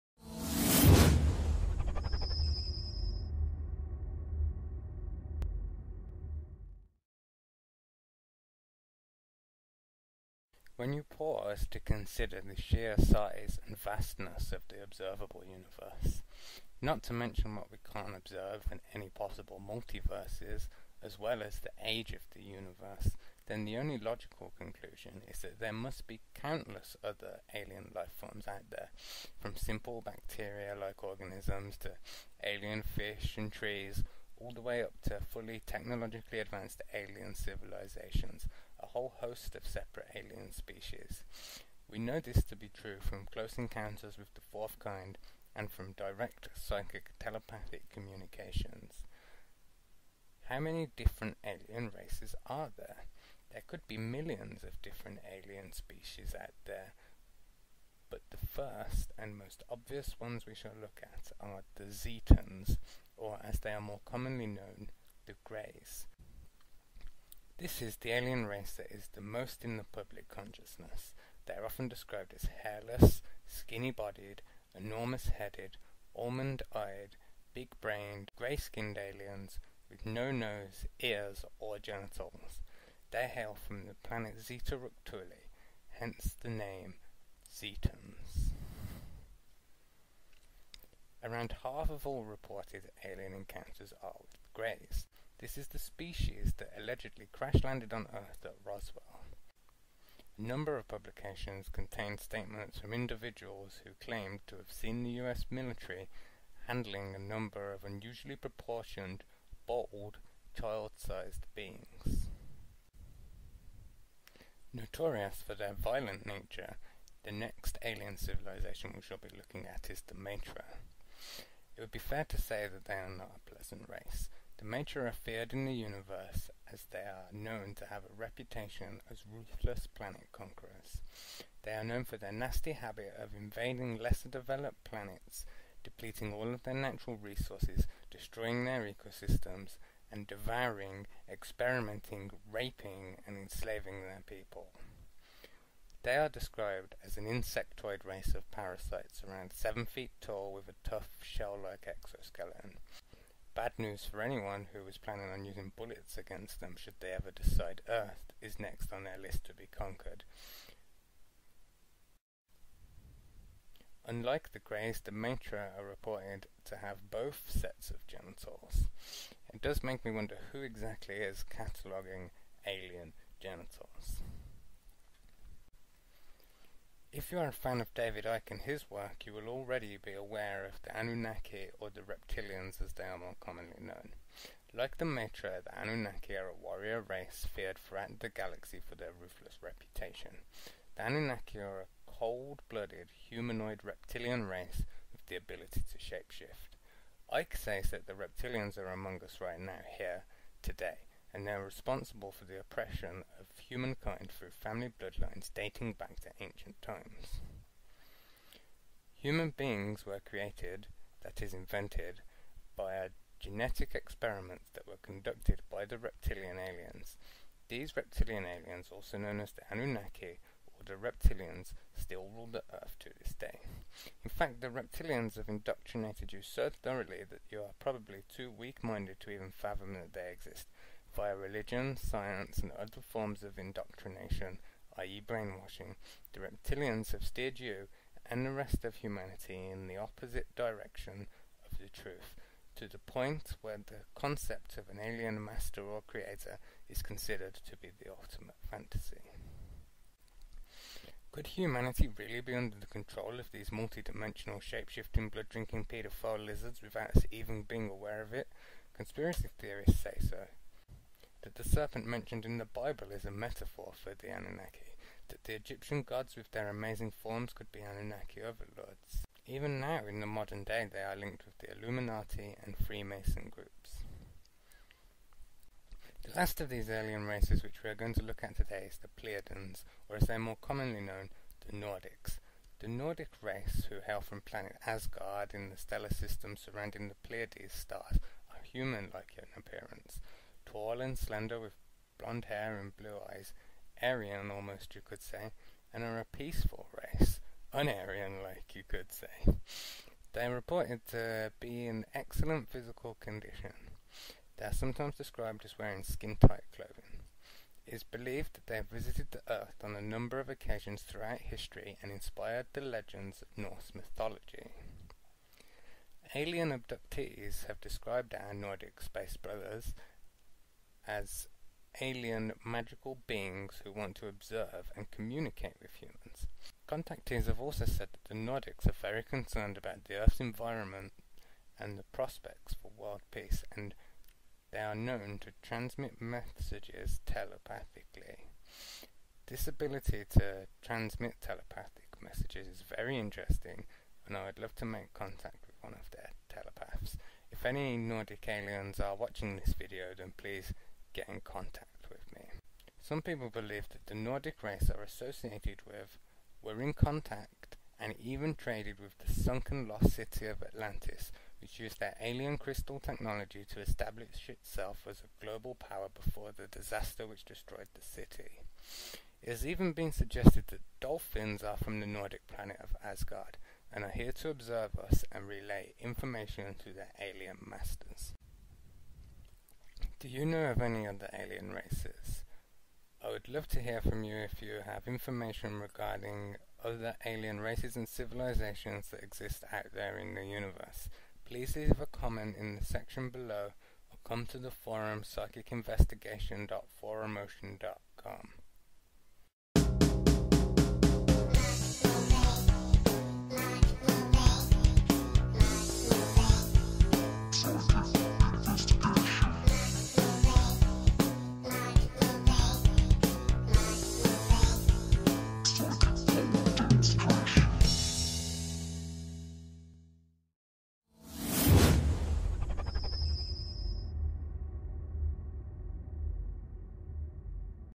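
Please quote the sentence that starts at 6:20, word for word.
Do you know of any other alien races?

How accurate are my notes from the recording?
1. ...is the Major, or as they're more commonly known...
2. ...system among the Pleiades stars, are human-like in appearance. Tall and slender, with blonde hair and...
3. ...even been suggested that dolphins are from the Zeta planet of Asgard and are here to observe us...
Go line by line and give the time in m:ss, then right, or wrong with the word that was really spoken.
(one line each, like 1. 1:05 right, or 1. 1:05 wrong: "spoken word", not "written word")
1. 4:38 wrong: "Pleiadians", not "Major"
2. 4:46 wrong: "surrounding", not "among"
3. 6:09 wrong: "Nordic", not "Zeta".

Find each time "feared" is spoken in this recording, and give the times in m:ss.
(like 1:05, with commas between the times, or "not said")
2:05, 3:07.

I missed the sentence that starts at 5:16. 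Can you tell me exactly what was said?
Alien abductees have described our Nordic space brothers as alien magical beings who want to observe and communicate with humans.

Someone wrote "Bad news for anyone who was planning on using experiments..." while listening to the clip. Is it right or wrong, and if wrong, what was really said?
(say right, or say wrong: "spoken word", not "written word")
wrong: "bullets", not "experiments".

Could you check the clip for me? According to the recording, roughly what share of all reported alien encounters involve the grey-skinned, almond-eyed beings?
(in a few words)
Around half.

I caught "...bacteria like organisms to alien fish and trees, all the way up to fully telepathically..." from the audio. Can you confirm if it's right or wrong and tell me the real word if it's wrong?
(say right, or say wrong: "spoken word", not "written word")
wrong: "technologically", not "telepathically".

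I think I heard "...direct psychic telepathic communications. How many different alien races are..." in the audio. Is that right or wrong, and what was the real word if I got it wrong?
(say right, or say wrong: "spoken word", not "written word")
right.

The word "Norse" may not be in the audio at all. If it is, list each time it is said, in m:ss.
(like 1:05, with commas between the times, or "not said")
5:13.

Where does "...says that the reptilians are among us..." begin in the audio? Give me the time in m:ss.
3:17.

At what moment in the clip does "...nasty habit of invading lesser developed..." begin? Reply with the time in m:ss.
2:12.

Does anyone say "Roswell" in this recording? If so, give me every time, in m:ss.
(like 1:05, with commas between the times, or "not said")
1:38.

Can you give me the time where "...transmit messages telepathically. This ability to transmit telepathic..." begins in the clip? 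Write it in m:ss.
5:35.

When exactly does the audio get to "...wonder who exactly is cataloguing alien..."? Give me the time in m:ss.
2:50.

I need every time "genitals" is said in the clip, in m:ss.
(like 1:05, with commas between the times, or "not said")
1:21, 2:48, 2:53.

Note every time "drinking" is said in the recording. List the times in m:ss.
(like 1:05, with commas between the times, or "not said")
4:15.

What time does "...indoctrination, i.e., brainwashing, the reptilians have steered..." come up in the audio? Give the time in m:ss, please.
3:53.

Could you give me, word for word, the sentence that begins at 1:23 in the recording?
They hail from the planet Zeta Reticuli, hence the name Zetans.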